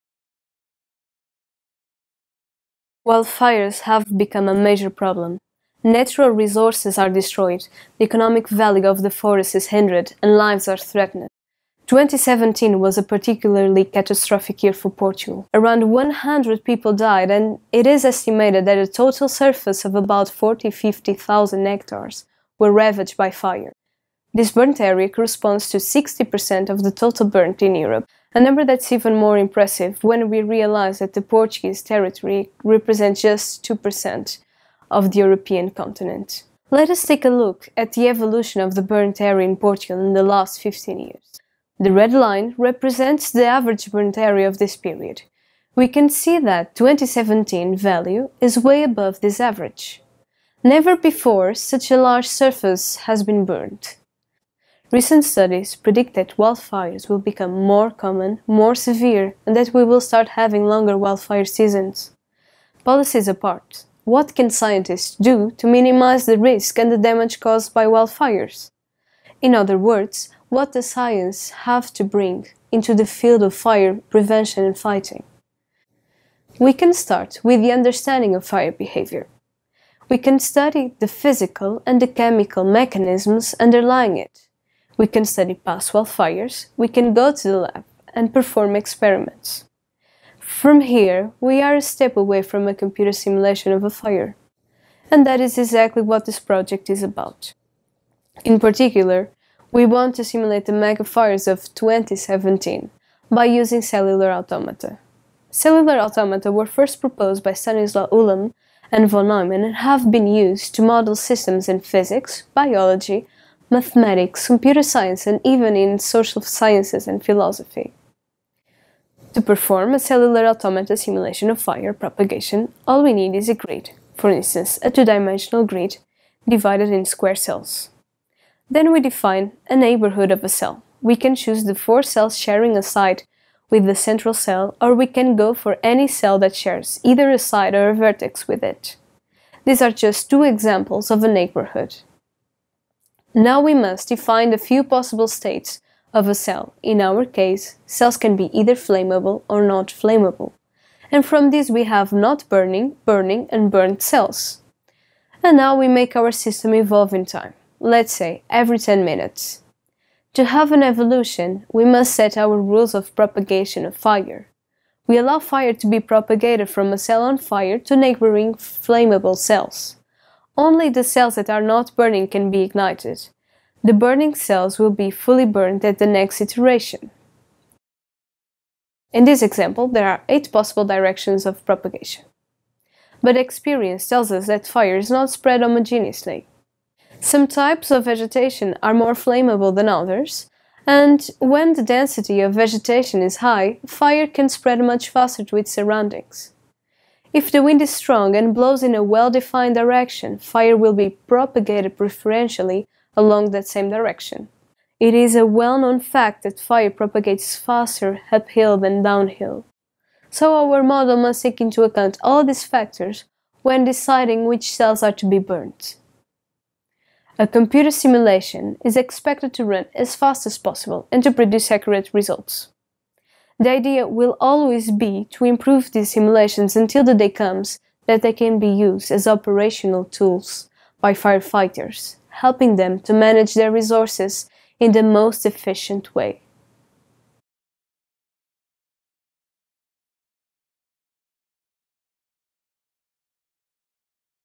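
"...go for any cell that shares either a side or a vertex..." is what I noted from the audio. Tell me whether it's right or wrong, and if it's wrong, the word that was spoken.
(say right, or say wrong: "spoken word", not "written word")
right.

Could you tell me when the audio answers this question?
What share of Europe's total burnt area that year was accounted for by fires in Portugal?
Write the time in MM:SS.
00:25.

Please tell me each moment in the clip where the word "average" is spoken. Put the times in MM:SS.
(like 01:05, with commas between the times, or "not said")
00:43, 00:49.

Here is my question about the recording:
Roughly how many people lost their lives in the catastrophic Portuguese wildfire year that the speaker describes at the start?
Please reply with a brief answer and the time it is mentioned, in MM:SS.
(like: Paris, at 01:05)
100, at 00:15.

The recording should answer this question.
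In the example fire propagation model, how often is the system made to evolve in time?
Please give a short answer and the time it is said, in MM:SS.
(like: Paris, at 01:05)
every 10 minutes, at 02:38.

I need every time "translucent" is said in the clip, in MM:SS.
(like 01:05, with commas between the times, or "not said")
not said.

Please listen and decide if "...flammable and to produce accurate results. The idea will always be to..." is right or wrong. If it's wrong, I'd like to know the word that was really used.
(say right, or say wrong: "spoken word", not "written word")
wrong: "possible", not "flammable".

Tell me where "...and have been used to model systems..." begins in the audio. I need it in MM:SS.
01:49.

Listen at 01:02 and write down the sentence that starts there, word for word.
Policies apart, what can scientists do to minimize the risk and the damage caused by wildfires?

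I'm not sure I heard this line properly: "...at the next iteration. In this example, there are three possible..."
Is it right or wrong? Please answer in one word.
wrong.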